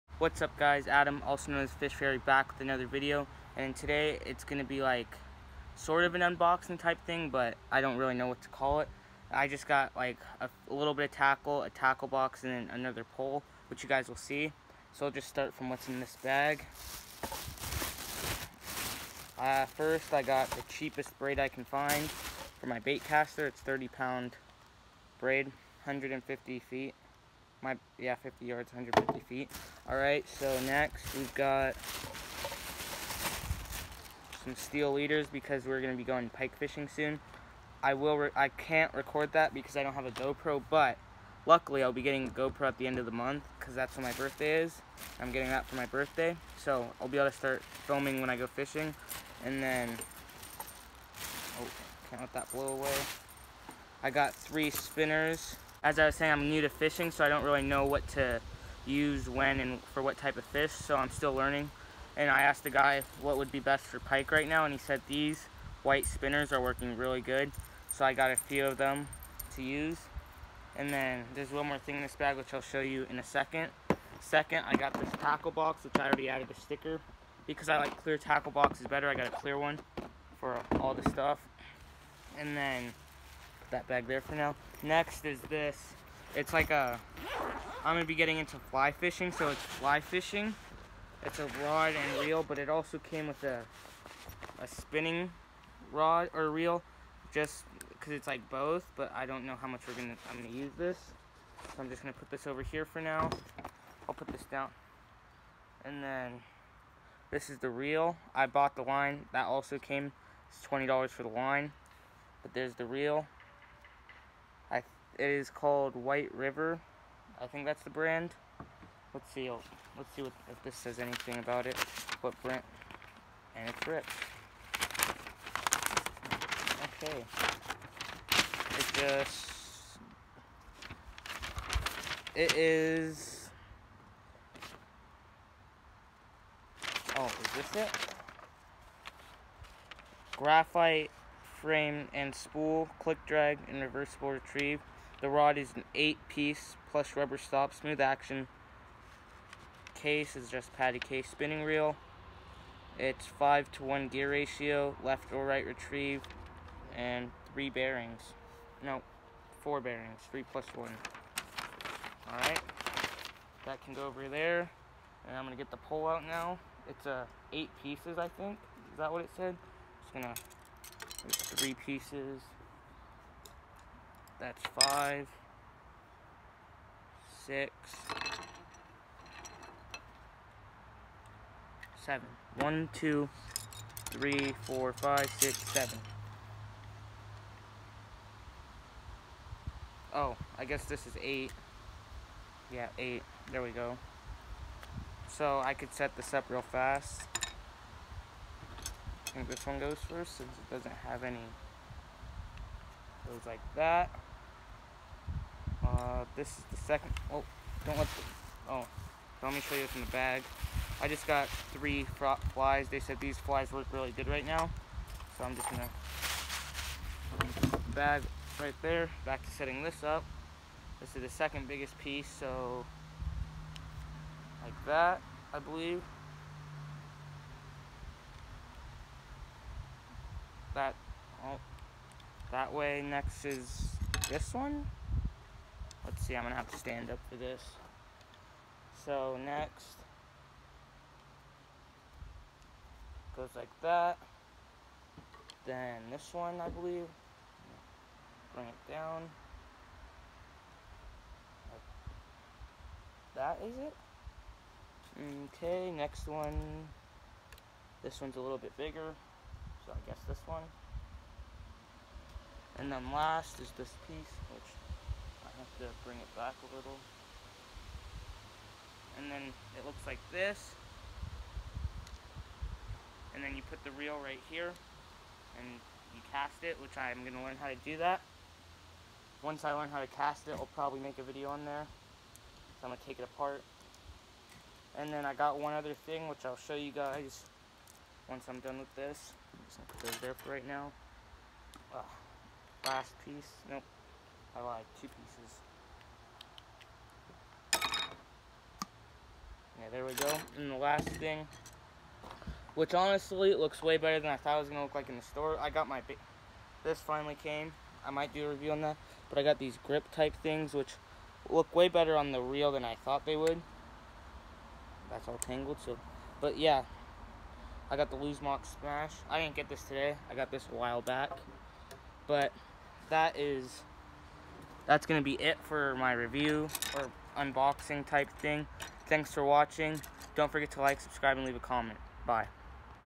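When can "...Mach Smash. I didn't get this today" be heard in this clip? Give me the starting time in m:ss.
5:18.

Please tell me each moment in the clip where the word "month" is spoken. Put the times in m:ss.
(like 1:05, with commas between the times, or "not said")
0:43.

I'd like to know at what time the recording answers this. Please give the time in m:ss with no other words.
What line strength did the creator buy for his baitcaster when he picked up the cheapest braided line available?
0:23.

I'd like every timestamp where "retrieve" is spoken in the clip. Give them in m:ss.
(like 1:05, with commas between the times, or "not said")
2:24, 2:35.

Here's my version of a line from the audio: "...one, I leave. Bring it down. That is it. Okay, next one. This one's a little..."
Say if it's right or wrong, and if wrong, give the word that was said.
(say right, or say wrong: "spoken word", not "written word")
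wrong: "believe", not "leave".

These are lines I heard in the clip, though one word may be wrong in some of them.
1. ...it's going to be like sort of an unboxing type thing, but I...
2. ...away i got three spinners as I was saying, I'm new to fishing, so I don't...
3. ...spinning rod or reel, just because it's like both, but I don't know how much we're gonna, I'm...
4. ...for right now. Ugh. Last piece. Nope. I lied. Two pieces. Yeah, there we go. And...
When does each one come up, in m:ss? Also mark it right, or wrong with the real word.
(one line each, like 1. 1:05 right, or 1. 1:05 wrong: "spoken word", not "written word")
1. 0:04 right
2. 0:52 right
3. 1:34 right
4. 4:50 right.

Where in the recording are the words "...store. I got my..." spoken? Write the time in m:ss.
5:05.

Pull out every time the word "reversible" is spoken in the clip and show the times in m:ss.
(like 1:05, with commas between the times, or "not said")
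2:23.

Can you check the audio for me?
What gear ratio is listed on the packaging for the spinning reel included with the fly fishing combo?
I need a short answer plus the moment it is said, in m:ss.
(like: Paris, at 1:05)
5 to 1, at 2:33.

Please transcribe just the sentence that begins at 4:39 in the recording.
Once I learn how to cast it, I'll probably make a video on there.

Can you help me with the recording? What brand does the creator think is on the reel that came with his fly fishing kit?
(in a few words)
White River.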